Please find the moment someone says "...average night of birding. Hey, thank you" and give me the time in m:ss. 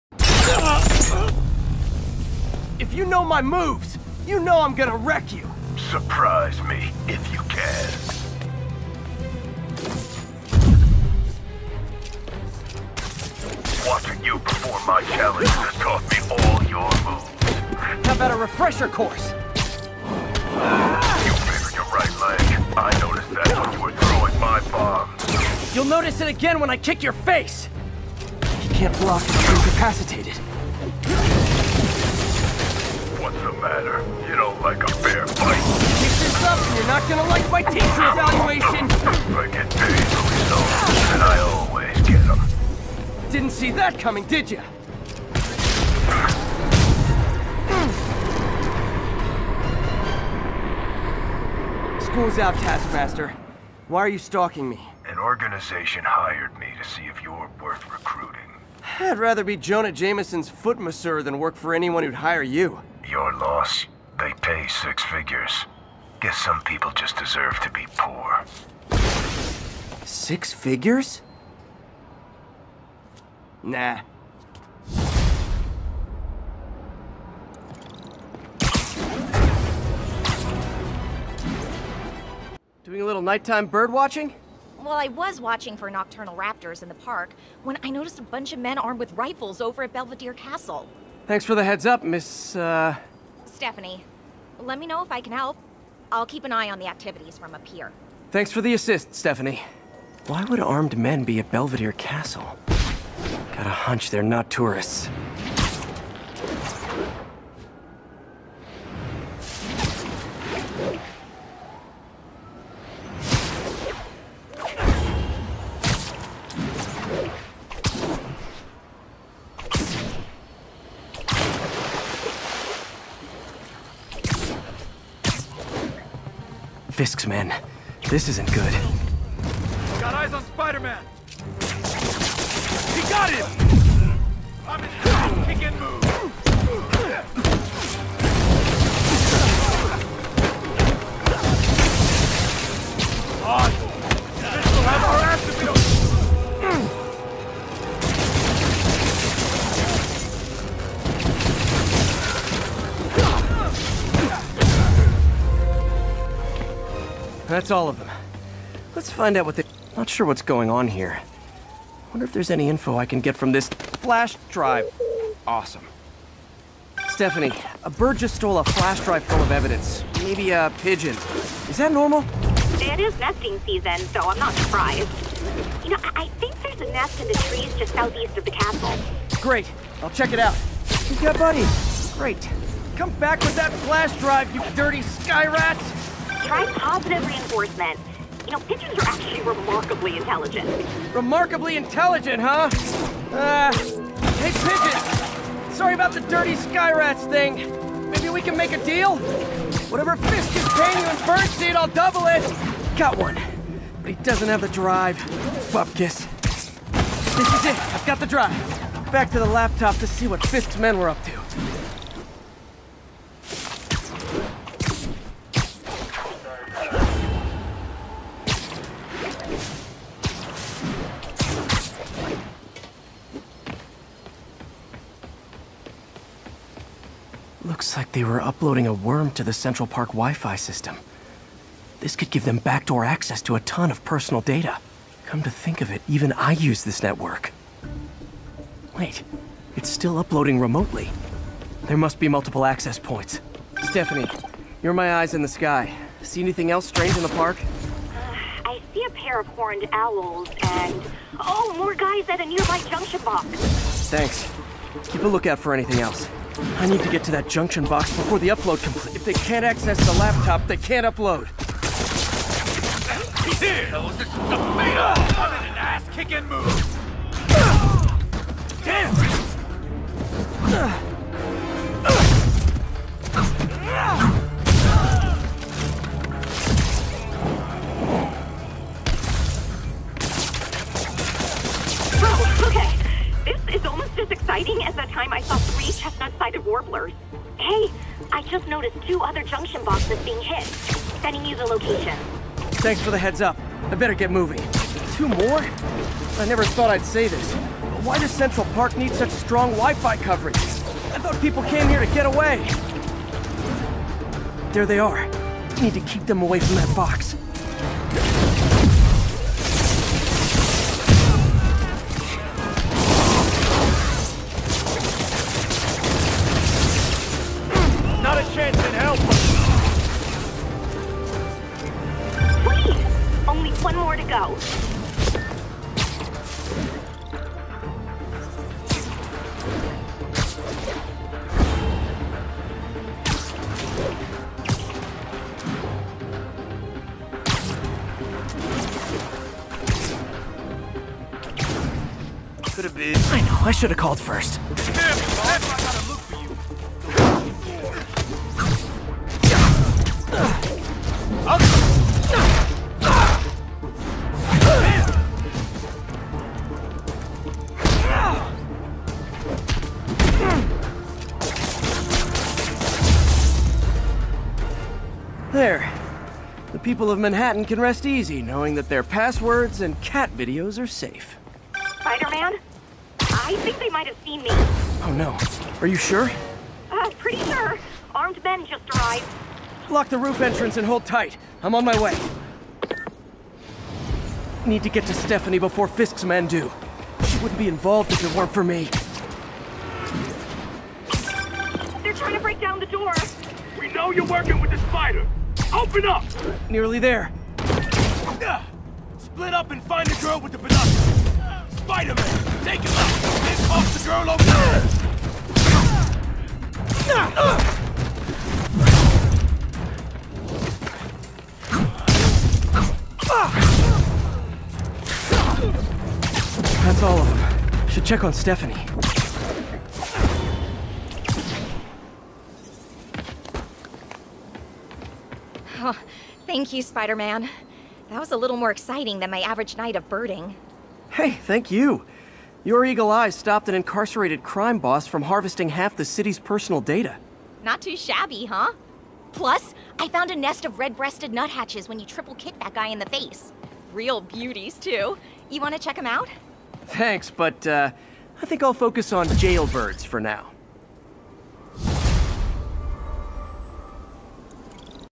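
7:09.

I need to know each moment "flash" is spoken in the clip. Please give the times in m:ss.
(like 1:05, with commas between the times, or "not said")
2:43, 2:48, 3:03.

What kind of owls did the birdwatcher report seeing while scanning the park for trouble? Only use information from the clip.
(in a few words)
horned owls.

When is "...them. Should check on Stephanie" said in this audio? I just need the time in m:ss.
6:57.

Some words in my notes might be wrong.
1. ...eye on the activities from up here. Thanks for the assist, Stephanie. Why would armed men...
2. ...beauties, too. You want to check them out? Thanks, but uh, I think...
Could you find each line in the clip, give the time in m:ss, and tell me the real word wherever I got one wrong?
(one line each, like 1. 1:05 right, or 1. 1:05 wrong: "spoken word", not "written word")
1. 1:36 right
2. 7:24 right.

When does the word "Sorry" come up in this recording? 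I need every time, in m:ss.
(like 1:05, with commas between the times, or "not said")
3:15.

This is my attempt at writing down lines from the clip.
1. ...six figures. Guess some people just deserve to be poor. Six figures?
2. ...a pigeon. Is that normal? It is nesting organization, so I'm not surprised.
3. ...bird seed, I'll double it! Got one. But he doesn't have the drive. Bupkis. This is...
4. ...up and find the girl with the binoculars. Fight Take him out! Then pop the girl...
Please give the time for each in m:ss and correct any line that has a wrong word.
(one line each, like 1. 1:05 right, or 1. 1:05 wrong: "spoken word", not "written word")
1. 1:04 right
2. 2:50 wrong: "season", not "organization"
3. 3:21 right
4. 6:39 right.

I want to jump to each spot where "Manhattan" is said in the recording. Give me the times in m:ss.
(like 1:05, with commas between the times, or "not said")
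6:07.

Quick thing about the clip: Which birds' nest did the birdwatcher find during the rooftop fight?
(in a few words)
red-breasted nuthatches.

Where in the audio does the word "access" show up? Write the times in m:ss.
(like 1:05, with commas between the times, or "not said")
3:53, 4:02, 4:19.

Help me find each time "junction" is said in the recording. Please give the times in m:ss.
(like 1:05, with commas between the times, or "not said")
4:12, 4:17, 4:49.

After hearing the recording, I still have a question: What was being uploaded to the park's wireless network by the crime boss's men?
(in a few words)
a worm.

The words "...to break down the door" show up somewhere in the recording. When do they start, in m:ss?
6:32.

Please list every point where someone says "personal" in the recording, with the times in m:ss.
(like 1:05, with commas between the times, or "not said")
3:54, 7:16.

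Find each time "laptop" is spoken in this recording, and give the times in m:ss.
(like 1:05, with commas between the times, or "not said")
3:29, 4:20.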